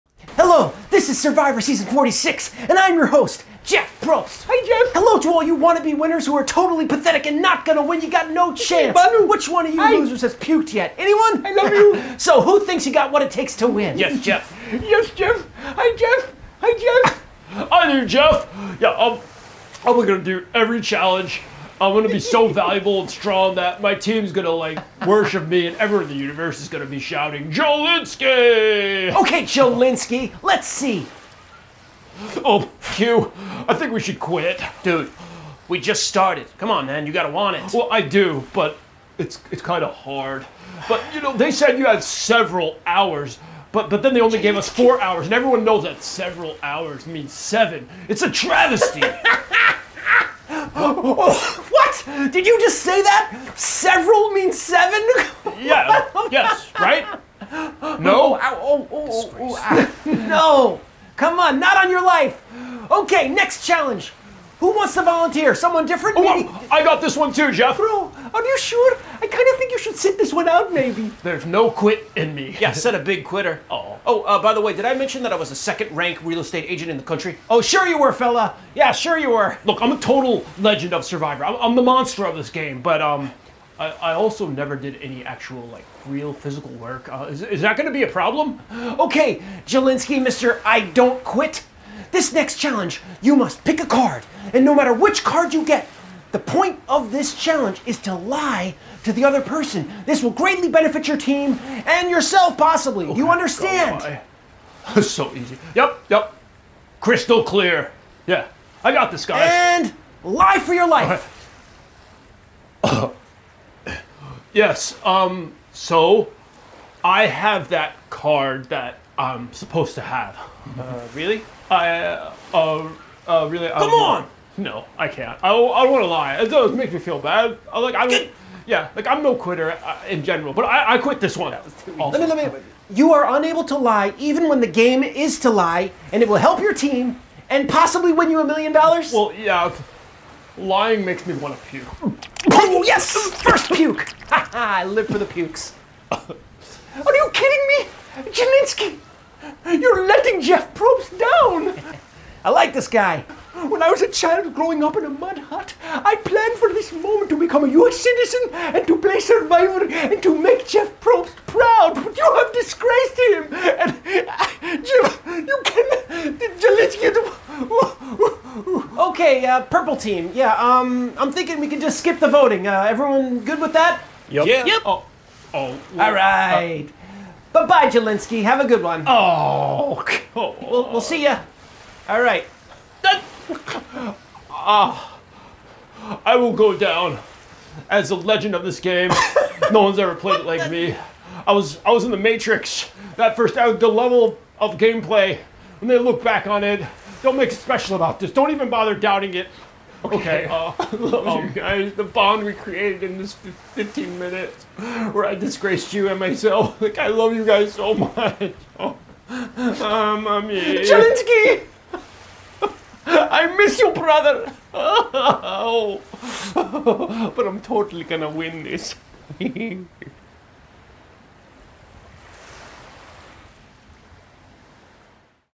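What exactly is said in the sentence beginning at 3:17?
Don't make it special about this.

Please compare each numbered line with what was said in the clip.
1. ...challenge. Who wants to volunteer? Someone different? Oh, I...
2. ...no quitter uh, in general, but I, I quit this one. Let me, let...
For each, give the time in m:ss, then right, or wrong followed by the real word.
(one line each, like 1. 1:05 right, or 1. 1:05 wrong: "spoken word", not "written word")
1. 1:03 right
2. 2:09 right.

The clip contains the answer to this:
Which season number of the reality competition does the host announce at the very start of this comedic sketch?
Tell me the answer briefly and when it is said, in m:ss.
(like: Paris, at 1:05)
46, at 0:01.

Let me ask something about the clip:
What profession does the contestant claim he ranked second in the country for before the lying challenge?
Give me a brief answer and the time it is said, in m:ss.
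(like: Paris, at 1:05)
real estate agent, at 1:16.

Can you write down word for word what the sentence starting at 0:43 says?
But, but then they only gave us four hours, and everyone knows that several hours means seven.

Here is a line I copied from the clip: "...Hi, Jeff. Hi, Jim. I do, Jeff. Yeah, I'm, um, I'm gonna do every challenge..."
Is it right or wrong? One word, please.
wrong.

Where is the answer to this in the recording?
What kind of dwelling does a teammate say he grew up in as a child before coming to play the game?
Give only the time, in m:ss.
2:35.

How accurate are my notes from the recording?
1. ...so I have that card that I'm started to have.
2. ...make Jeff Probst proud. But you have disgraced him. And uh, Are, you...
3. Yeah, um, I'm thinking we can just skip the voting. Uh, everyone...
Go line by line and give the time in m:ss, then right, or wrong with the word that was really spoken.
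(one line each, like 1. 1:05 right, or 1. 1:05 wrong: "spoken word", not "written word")
1. 1:55 wrong: "supposed", not "started"
2. 2:40 wrong: "Jim", not "Are"
3. 2:50 right.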